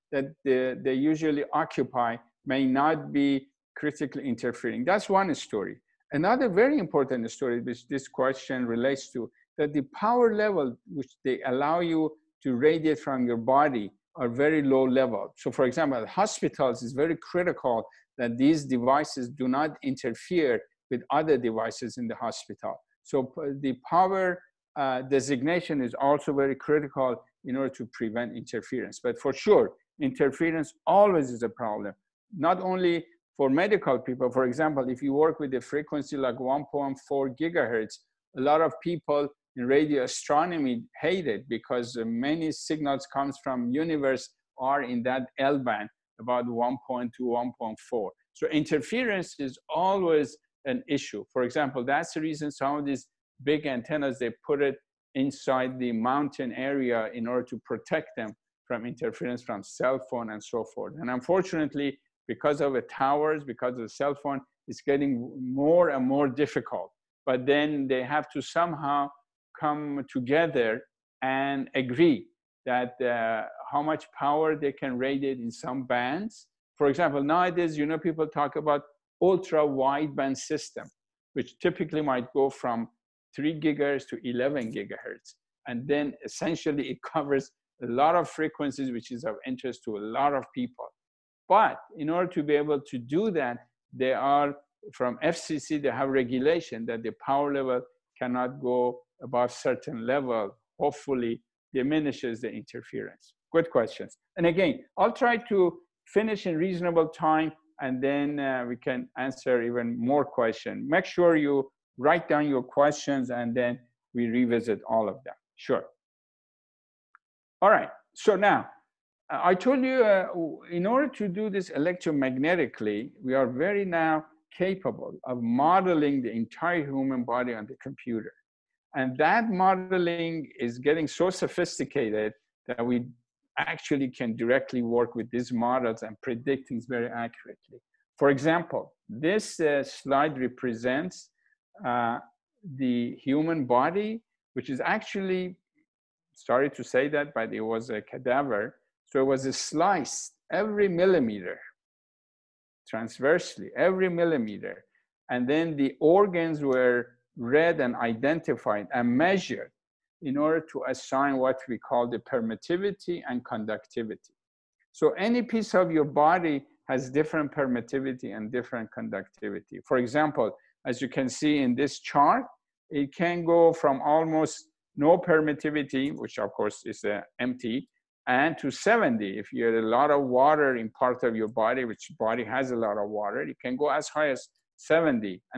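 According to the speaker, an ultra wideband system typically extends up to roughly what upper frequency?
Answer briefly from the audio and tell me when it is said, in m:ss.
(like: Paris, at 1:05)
11 gigahertz, at 1:24.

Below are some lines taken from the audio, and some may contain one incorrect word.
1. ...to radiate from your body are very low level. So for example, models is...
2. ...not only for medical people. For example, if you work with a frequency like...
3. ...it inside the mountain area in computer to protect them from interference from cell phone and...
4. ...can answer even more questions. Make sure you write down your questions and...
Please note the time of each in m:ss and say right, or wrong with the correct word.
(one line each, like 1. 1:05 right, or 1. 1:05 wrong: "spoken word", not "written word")
1. 0:12 wrong: "hospitals", not "models"
2. 0:32 right
3. 0:54 wrong: "order", not "computer"
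4. 1:48 right.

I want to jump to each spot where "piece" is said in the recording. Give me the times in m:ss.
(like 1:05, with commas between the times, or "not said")
2:45.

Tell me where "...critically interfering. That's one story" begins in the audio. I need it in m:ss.
0:03.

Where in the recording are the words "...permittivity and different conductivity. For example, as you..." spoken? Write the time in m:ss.
2:47.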